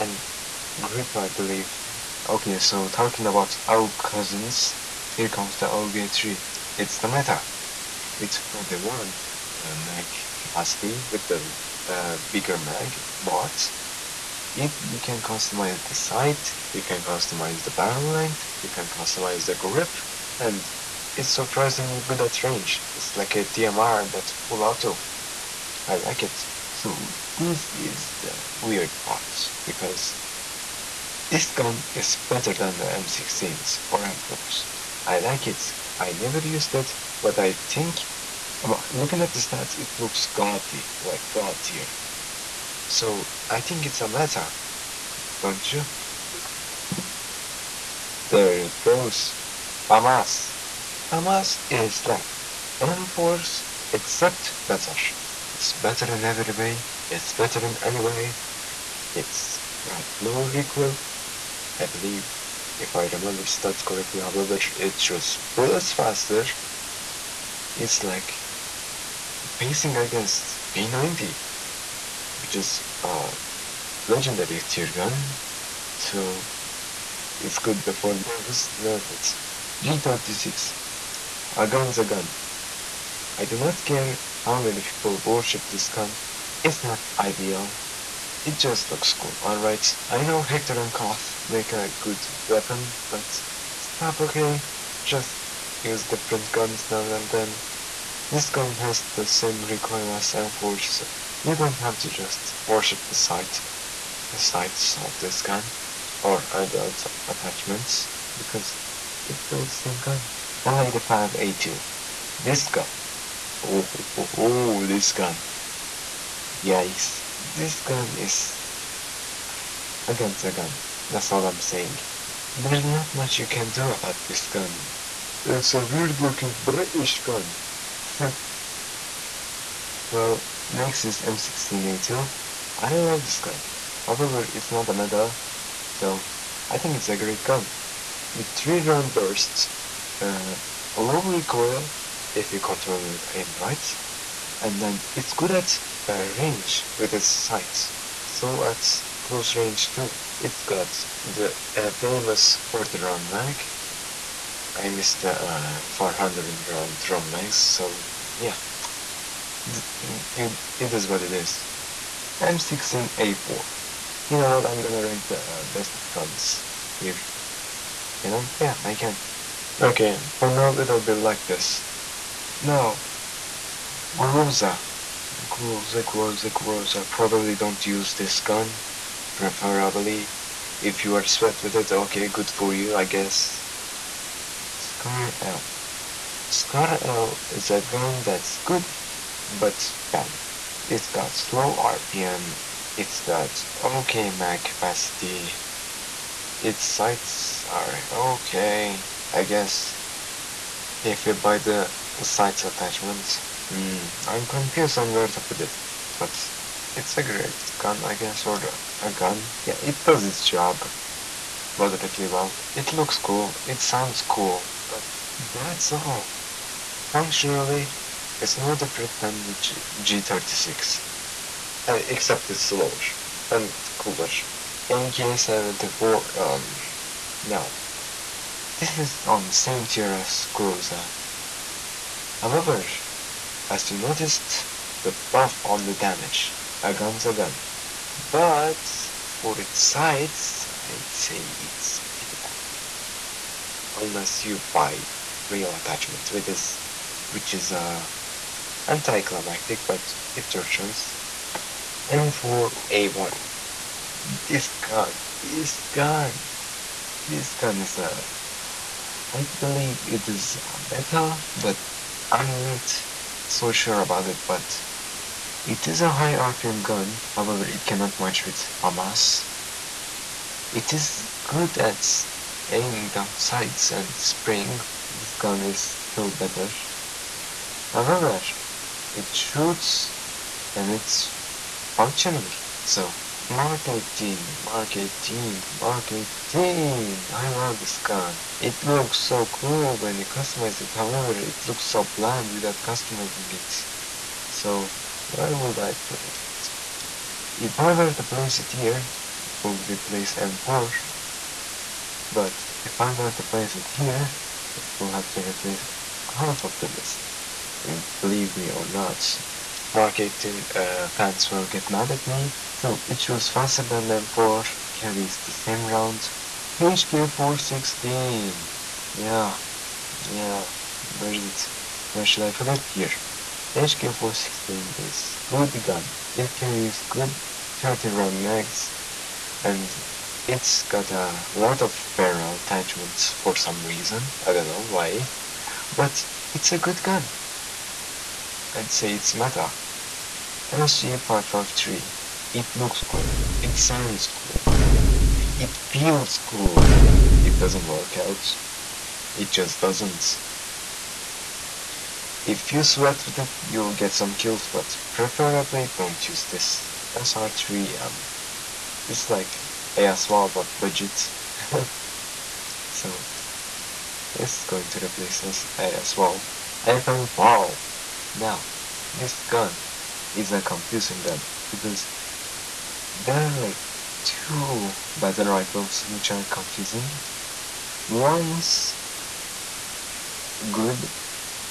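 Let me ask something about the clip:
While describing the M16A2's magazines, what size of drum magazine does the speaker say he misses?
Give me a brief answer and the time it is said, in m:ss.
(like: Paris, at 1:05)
400 round, at 2:35.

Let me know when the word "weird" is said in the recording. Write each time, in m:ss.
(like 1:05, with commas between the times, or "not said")
0:28, 2:05.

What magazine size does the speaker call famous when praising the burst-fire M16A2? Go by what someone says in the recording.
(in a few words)
40 round.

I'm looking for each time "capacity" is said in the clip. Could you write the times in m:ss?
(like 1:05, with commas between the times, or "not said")
0:10, 3:14.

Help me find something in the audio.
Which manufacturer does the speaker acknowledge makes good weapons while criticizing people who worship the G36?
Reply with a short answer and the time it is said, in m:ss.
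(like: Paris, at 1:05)
Heckler and Koch, at 1:30.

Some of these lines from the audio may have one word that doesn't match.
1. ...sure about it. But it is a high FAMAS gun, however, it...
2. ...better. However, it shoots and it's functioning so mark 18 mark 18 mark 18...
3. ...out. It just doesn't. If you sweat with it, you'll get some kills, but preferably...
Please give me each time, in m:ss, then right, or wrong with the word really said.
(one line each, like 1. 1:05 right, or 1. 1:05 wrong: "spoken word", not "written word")
1. 4:23 wrong: "RPM", not "FAMAS"
2. 4:36 right
3. 5:48 right.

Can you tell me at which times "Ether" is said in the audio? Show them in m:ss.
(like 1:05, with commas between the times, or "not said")
6:06.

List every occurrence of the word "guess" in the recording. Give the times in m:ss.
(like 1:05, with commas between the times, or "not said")
3:03, 3:19, 3:28.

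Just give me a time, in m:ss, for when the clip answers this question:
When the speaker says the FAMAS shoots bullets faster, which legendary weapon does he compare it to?
1:10.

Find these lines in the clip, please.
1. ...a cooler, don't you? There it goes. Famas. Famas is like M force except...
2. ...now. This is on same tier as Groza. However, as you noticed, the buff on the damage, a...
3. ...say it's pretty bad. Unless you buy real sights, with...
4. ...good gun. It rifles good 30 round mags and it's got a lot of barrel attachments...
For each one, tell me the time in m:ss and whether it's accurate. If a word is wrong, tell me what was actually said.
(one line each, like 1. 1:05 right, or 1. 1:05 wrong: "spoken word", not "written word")
1. 0:44 wrong: "letter", not "cooler"
2. 3:47 right
3. 4:01 wrong: "attachments", not "sights"
4. 5:25 wrong: "carries", not "rifles".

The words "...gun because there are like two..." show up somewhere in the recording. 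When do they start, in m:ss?
6:11.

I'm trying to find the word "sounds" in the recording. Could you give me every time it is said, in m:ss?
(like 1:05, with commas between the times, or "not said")
3:33, 5:43.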